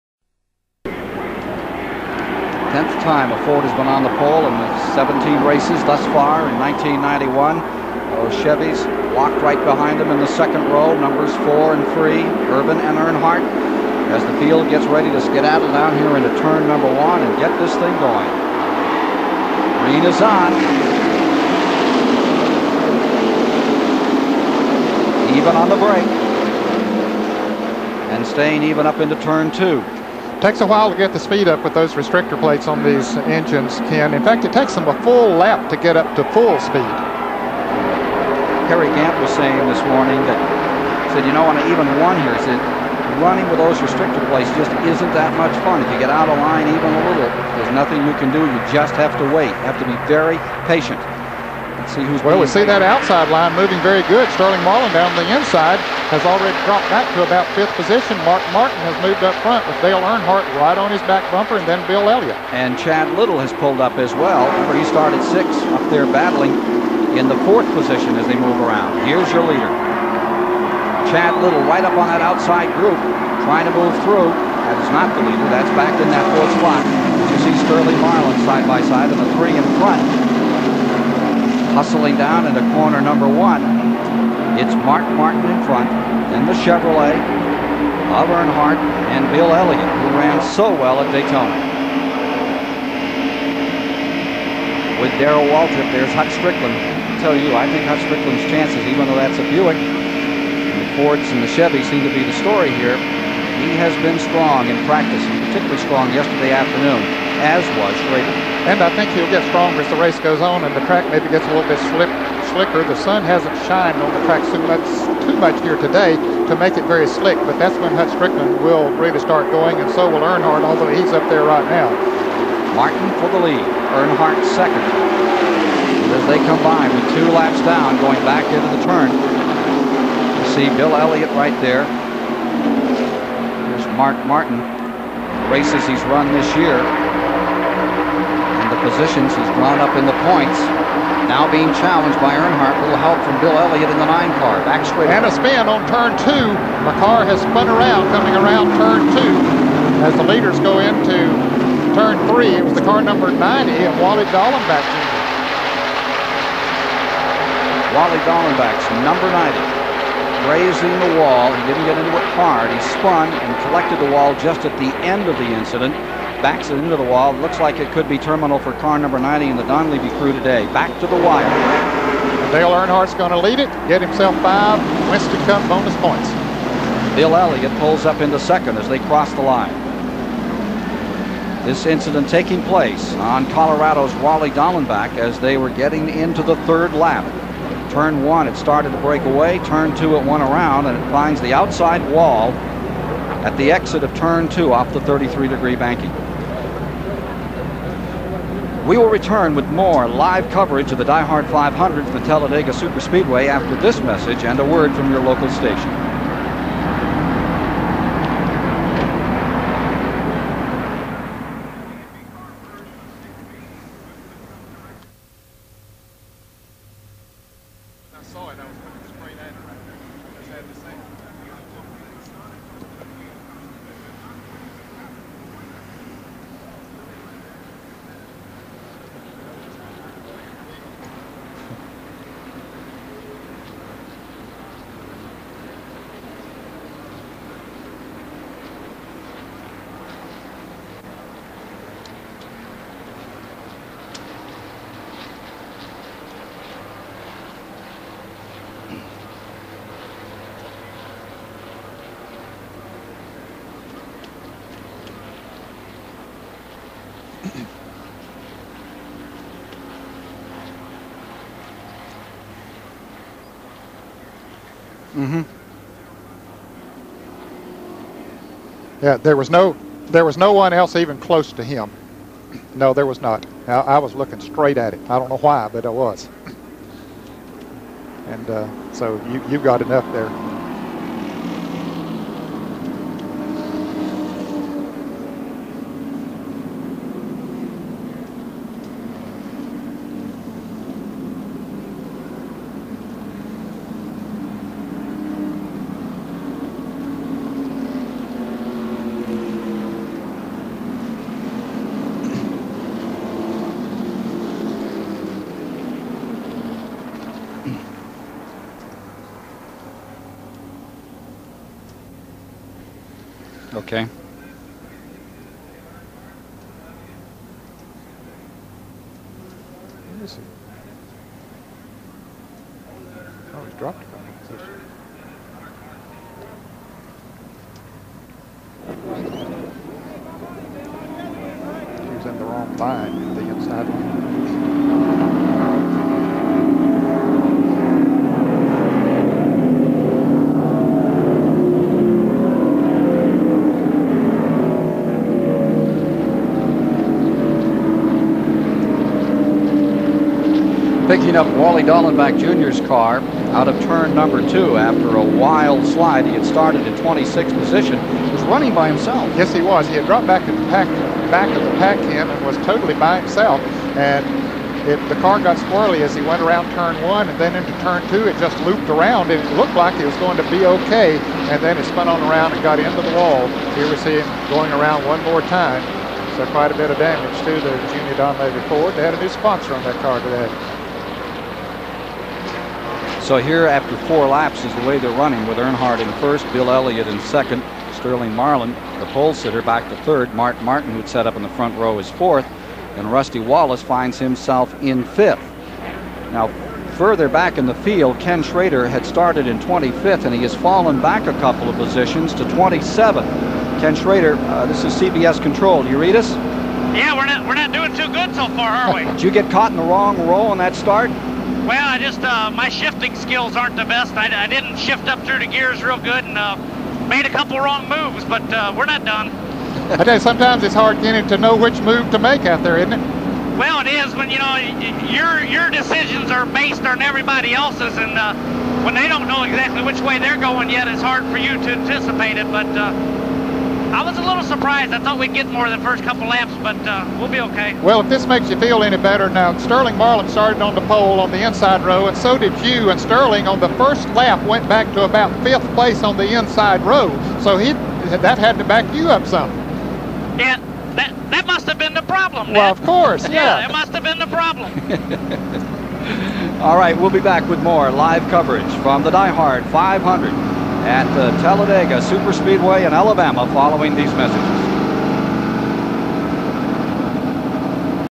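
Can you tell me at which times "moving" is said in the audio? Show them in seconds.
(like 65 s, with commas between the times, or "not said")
53 s.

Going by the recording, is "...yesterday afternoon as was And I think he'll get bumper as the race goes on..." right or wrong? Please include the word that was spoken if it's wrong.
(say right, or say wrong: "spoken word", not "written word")
wrong: "stronger", not "bumper".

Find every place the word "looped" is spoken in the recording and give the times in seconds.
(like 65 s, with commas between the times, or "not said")
368 s.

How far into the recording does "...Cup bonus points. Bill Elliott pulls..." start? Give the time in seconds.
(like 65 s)
175 s.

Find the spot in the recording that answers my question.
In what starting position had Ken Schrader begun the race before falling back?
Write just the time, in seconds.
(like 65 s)
399 s.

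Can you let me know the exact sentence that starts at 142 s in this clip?
A little help from Bill Elliott in the nine car.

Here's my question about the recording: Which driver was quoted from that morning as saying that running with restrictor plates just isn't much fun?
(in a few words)
Harry Gant.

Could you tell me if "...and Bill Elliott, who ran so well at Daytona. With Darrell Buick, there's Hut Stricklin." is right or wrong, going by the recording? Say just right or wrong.
wrong.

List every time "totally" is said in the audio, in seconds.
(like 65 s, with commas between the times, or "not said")
362 s.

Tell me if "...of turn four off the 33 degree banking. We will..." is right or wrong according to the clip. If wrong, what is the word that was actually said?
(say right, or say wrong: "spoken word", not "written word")
wrong: "two", not "four".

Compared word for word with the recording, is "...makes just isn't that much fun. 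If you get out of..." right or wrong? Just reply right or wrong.
wrong.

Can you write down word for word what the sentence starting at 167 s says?
Looks like it could be terminal for car number 90 in the Donlavey crew today.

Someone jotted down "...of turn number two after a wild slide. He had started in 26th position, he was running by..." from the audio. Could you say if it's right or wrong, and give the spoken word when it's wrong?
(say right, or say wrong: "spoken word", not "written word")
right.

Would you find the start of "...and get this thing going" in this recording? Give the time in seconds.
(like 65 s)
17 s.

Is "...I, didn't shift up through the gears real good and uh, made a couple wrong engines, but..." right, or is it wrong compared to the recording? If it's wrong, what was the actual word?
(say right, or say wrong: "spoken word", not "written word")
wrong: "moves", not "engines".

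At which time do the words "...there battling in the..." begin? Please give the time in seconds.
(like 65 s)
65 s.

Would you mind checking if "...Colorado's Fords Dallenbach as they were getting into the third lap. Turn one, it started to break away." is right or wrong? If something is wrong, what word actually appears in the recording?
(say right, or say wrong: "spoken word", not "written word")
wrong: "Wally", not "Fords".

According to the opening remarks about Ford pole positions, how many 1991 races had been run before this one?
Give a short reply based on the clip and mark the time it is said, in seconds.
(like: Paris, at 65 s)
17, at 4 s.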